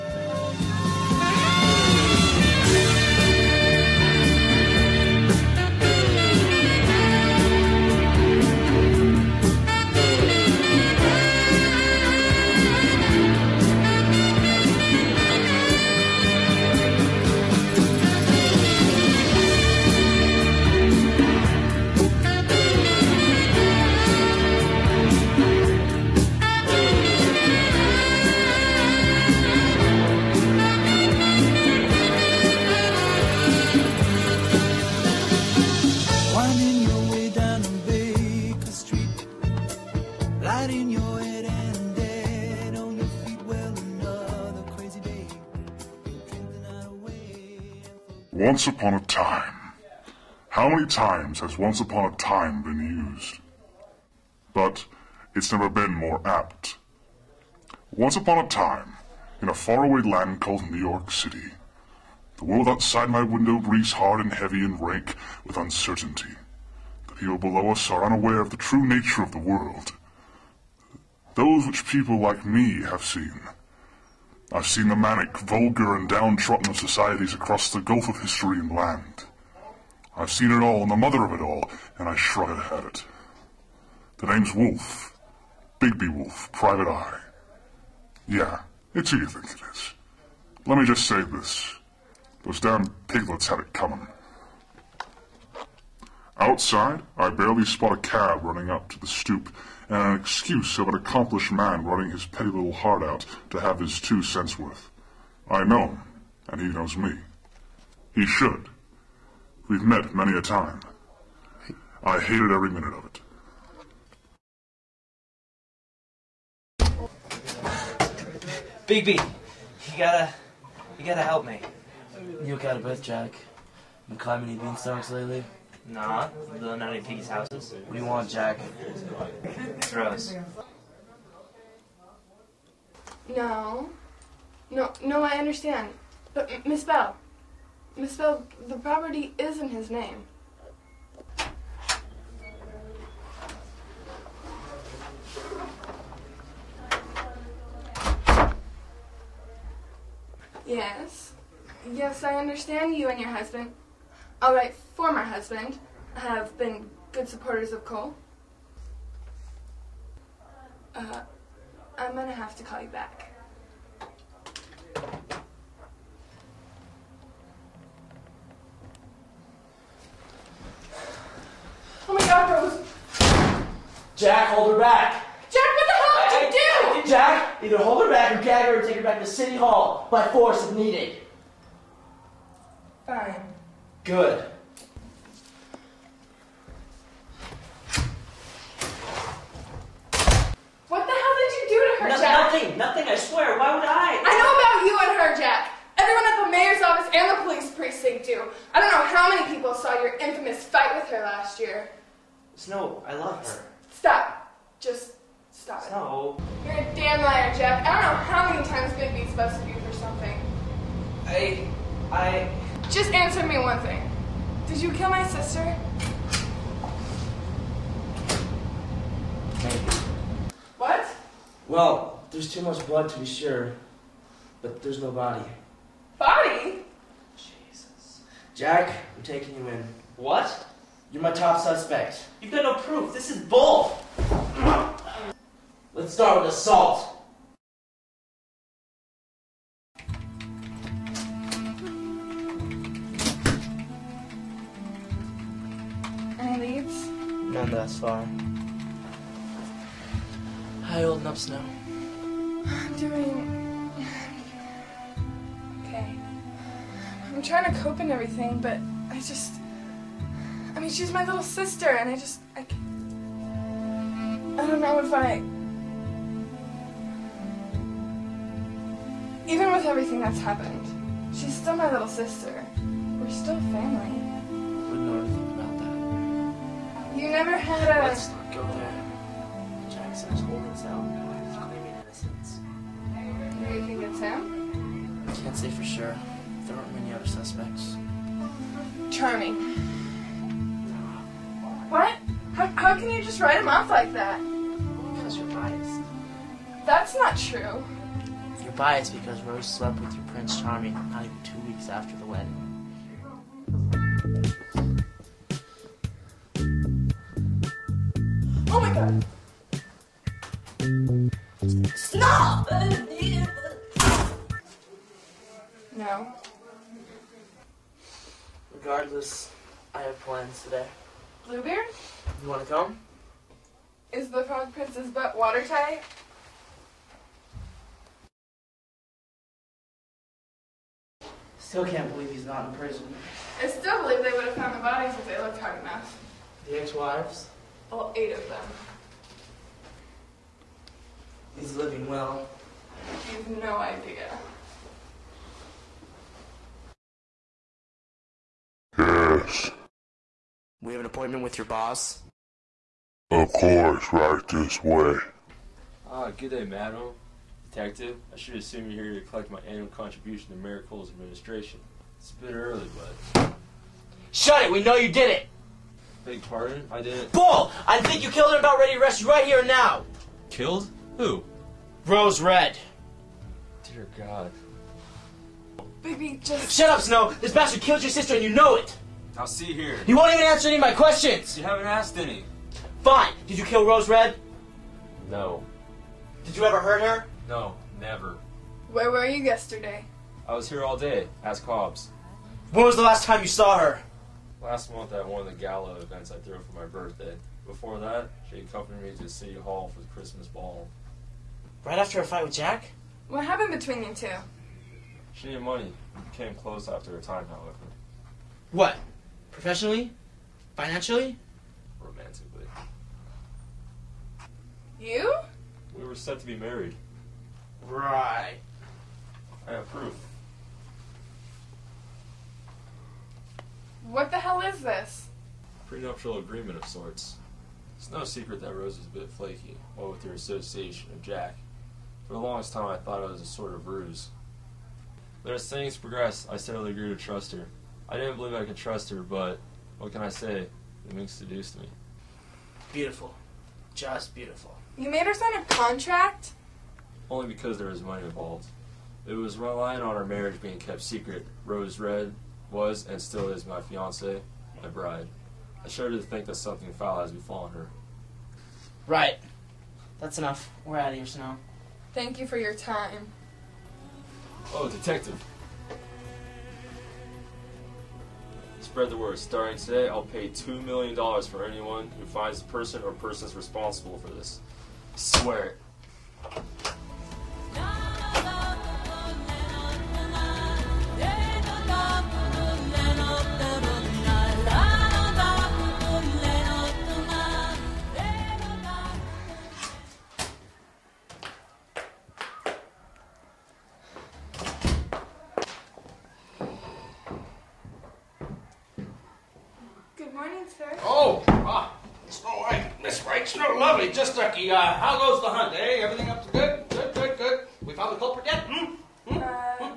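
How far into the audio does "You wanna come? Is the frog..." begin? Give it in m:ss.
5:22.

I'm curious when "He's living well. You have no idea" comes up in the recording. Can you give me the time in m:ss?
5:41.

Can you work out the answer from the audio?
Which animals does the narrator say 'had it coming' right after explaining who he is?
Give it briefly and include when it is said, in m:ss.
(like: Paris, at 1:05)
piglets, at 1:33.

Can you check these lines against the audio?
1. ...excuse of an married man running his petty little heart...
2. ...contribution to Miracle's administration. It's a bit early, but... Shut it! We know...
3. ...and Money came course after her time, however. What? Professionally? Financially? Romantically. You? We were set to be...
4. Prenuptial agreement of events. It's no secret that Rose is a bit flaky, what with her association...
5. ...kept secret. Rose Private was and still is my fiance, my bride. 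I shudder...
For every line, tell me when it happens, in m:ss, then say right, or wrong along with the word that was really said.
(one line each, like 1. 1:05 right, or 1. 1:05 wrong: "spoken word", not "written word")
1. 1:40 wrong: "accomplished", not "married"
2. 5:59 right
3. 6:45 wrong: "close", not "course"
4. 7:05 wrong: "sorts", not "events"
5. 7:30 wrong: "Red", not "Private".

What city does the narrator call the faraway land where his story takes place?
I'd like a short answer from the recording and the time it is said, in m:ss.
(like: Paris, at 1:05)
New York City, at 1:00.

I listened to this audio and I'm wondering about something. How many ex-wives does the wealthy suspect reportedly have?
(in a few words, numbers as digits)
8.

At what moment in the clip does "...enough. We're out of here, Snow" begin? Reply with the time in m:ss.
7:40.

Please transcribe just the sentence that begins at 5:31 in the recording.
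Still can't believe he's not in prison.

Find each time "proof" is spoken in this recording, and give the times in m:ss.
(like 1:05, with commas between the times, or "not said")
3:52, 6:59.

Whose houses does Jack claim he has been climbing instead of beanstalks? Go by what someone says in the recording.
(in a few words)
Nanny Piggy.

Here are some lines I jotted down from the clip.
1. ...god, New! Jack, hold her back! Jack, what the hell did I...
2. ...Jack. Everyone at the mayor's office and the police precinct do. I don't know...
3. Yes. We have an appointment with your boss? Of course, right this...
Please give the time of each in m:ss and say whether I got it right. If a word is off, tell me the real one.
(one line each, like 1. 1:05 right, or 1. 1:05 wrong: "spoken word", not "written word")
1. 2:52 wrong: "Rose", not "New"
2. 3:15 right
3. 5:48 right.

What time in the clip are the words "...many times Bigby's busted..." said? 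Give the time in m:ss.
3:28.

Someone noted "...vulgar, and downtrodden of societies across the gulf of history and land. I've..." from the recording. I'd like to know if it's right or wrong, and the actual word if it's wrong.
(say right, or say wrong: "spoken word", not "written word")
right.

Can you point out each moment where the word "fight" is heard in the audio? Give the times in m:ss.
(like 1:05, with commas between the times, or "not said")
3:20, 6:42.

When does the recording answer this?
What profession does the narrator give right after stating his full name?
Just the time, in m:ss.
1:26.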